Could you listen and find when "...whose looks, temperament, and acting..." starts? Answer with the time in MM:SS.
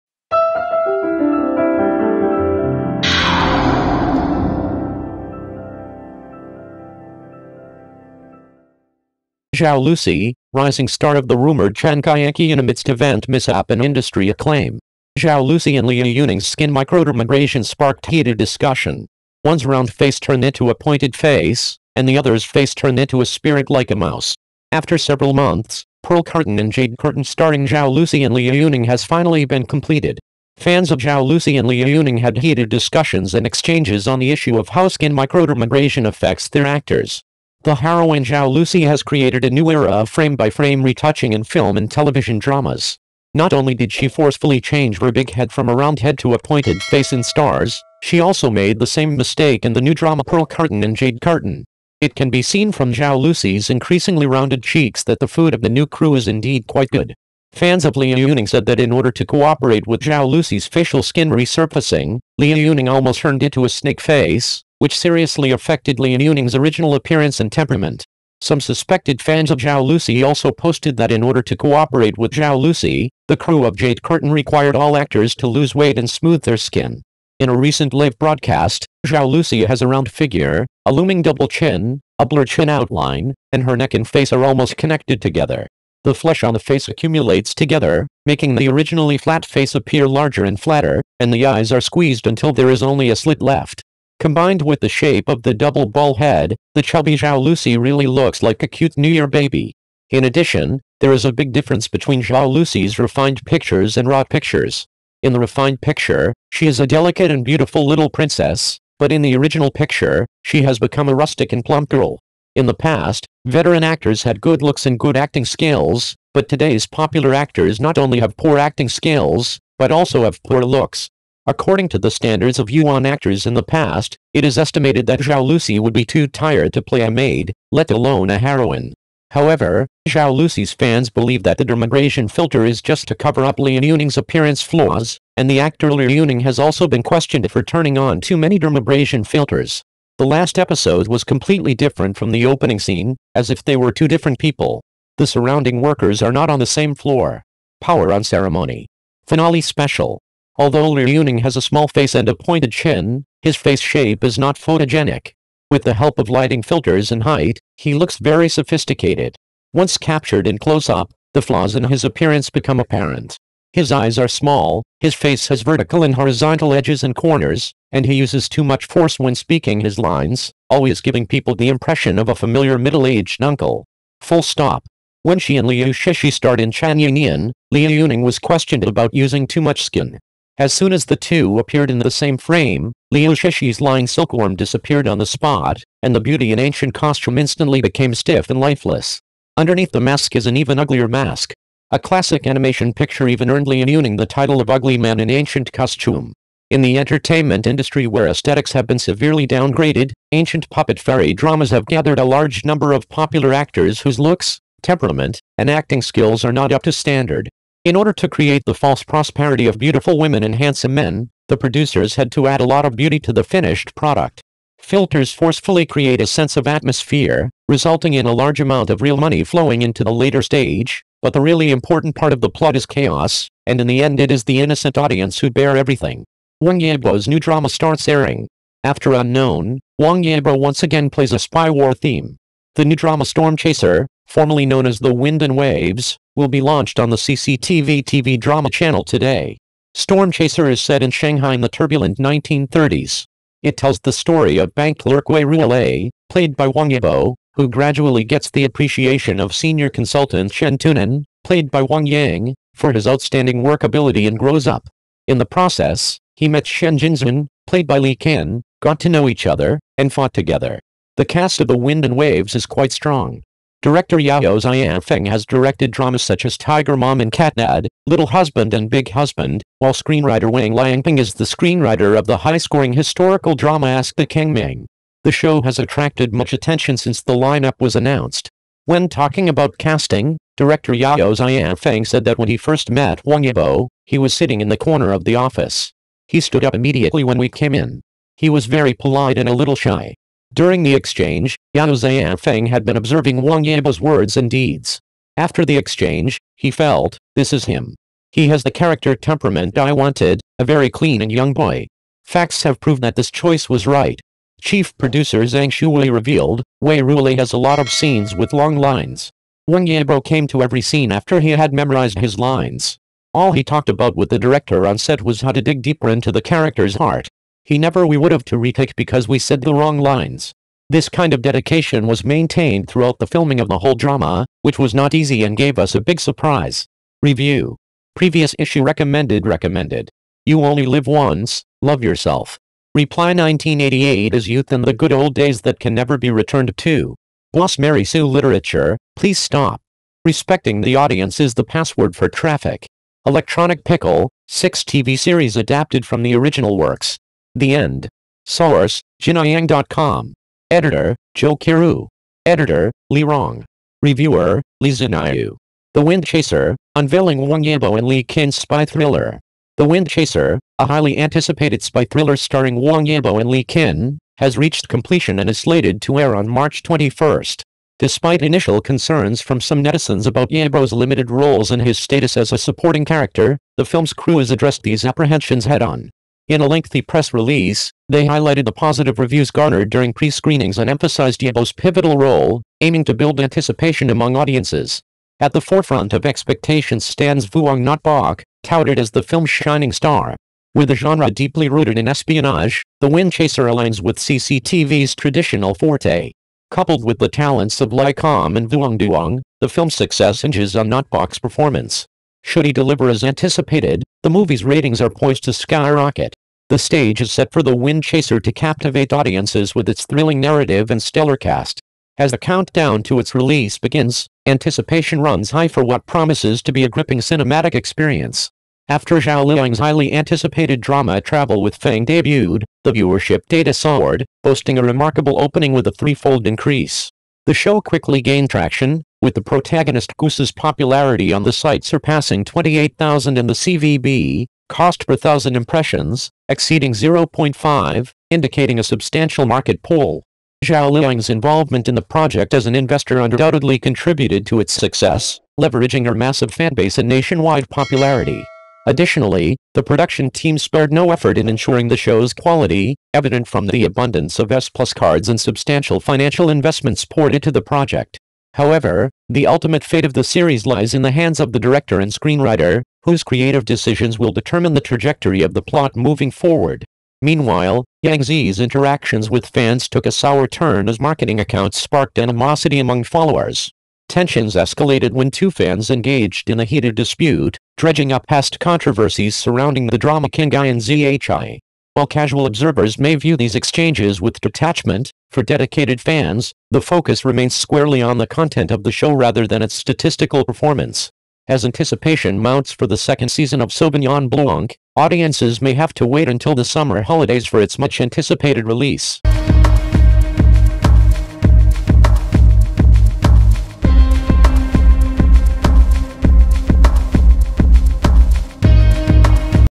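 03:24.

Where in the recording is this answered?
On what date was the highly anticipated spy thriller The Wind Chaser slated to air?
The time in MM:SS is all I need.
06:06.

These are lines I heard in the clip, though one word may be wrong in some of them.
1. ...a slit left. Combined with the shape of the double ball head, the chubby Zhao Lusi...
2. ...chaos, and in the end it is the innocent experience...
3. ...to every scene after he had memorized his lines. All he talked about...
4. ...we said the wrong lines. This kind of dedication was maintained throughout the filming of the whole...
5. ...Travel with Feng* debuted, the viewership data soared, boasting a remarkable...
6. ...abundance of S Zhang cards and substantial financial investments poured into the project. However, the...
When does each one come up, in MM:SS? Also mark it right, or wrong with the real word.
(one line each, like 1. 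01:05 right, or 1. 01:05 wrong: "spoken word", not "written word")
1. 01:33 right
2. 03:42 wrong: "audience", not "experience"
3. 05:10 right
4. 05:19 right
5. 07:01 right
6. 07:33 wrong: "Plus", not "Zhang".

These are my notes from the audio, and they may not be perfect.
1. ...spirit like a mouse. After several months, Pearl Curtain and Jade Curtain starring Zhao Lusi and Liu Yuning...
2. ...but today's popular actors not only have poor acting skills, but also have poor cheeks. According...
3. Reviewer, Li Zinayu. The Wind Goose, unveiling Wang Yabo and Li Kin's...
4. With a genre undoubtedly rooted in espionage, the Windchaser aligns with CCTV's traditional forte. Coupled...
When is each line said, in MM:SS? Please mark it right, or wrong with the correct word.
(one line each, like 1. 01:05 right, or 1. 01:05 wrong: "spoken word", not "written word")
1. 00:23 right
2. 01:56 wrong: "looks", not "cheeks"
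3. 05:54 wrong: "Chaser", not "Goose"
4. 06:30 wrong: "deeply", not "undoubtedly".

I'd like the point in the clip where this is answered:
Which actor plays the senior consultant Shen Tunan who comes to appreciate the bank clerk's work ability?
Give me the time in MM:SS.
04:11.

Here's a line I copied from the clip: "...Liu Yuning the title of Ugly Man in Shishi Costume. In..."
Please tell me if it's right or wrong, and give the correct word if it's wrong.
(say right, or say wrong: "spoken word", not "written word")
wrong: "Ancient", not "Shishi".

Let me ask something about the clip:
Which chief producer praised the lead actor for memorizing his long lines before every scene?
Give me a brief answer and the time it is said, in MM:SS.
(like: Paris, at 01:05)
Zhang Shuwei, at 05:05.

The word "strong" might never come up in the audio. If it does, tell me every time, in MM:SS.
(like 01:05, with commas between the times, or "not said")
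04:22.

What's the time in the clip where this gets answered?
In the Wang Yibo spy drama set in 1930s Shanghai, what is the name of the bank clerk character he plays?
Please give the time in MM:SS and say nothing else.
04:05.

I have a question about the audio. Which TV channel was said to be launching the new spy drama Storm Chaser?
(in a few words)
CCTV TV drama channel.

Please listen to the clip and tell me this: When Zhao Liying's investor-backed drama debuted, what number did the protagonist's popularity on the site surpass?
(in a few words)
28,000.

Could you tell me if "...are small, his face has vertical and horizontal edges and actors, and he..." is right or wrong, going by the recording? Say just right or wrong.
wrong.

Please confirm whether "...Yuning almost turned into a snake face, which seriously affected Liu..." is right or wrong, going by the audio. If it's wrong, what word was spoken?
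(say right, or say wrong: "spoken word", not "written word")
right.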